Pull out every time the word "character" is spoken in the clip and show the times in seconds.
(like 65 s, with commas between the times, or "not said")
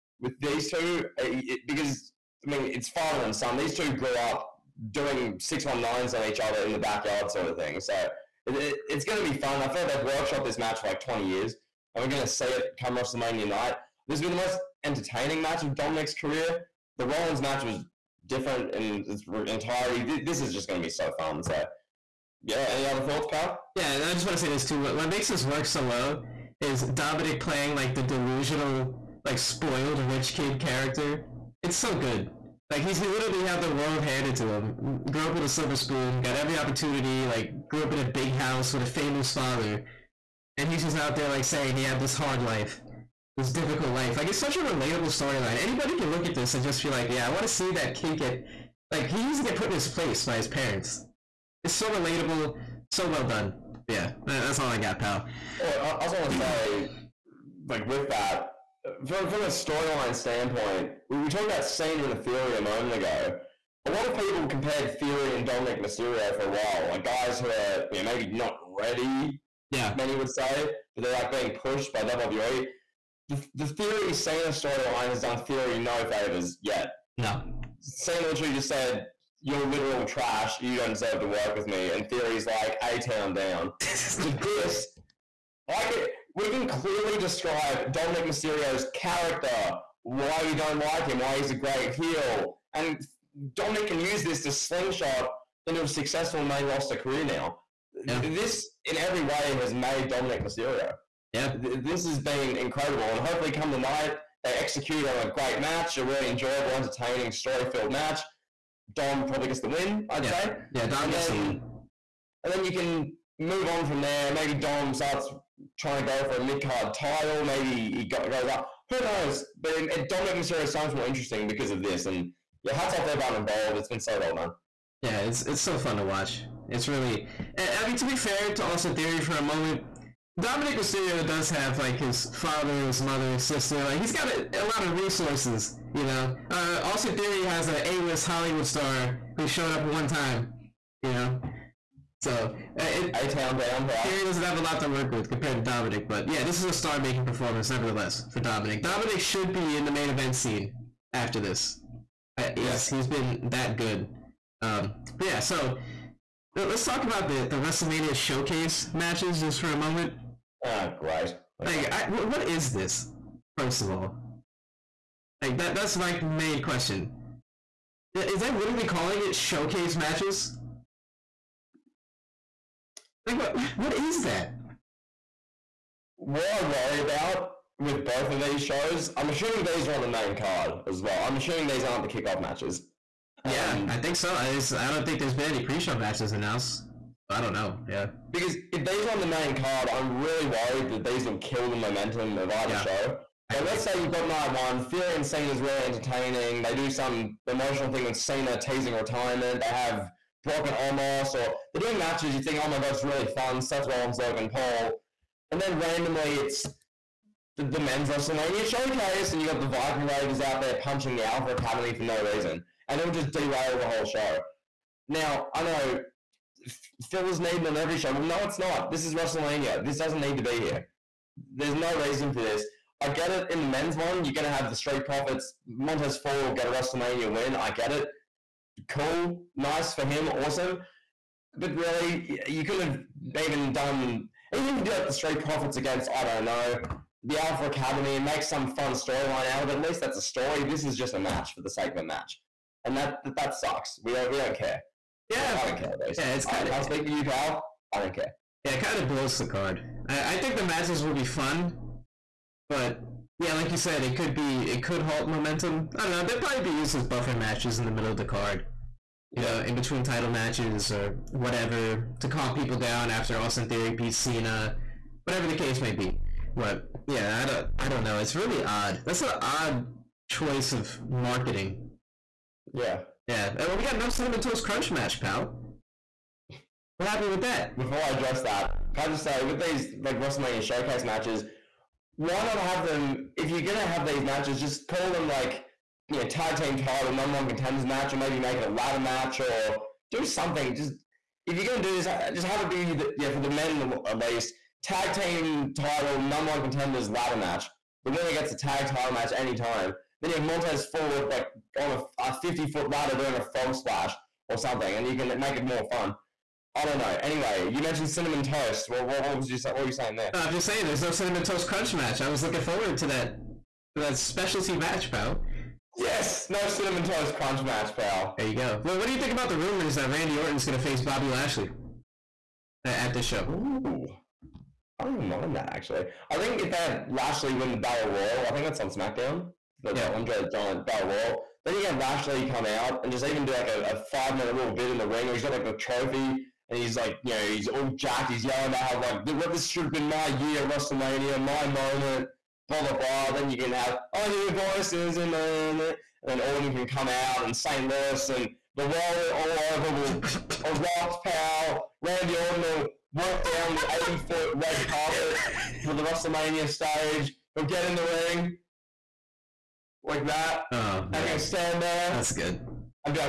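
30 s, 88 s.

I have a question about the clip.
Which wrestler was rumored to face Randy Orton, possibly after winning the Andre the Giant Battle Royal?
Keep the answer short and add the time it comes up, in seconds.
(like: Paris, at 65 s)
Bobby Lashley, at 321 s.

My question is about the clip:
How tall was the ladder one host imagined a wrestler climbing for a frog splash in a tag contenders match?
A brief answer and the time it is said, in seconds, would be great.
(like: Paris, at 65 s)
50 feet, at 302 s.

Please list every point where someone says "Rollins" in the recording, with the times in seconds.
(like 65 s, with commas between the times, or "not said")
17 s, 203 s.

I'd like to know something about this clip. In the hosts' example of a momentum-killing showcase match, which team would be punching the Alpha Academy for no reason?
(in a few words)
Viking Raiders.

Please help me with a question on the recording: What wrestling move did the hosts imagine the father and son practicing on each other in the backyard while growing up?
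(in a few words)
619.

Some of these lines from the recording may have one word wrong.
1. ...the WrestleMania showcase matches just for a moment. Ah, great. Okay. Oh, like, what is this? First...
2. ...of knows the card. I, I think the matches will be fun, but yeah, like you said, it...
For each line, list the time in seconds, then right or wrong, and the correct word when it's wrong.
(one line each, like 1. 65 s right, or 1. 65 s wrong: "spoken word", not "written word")
1. 157 s right
2. 248 s wrong: "blows", not "knows".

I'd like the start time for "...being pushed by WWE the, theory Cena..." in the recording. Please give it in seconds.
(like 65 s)
71 s.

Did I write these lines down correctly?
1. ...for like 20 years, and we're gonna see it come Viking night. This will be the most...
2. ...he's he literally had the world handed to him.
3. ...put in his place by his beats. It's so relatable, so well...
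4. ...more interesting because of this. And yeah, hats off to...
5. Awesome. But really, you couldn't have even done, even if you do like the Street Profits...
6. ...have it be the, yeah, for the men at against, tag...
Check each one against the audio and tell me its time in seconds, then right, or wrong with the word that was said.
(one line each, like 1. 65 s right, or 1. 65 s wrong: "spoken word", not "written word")
1. 10 s wrong: "WrestleMania", not "Viking"
2. 32 s right
3. 49 s wrong: "parents", not "beats"
4. 120 s right
5. 230 s right
6. 292 s wrong: "least", not "against".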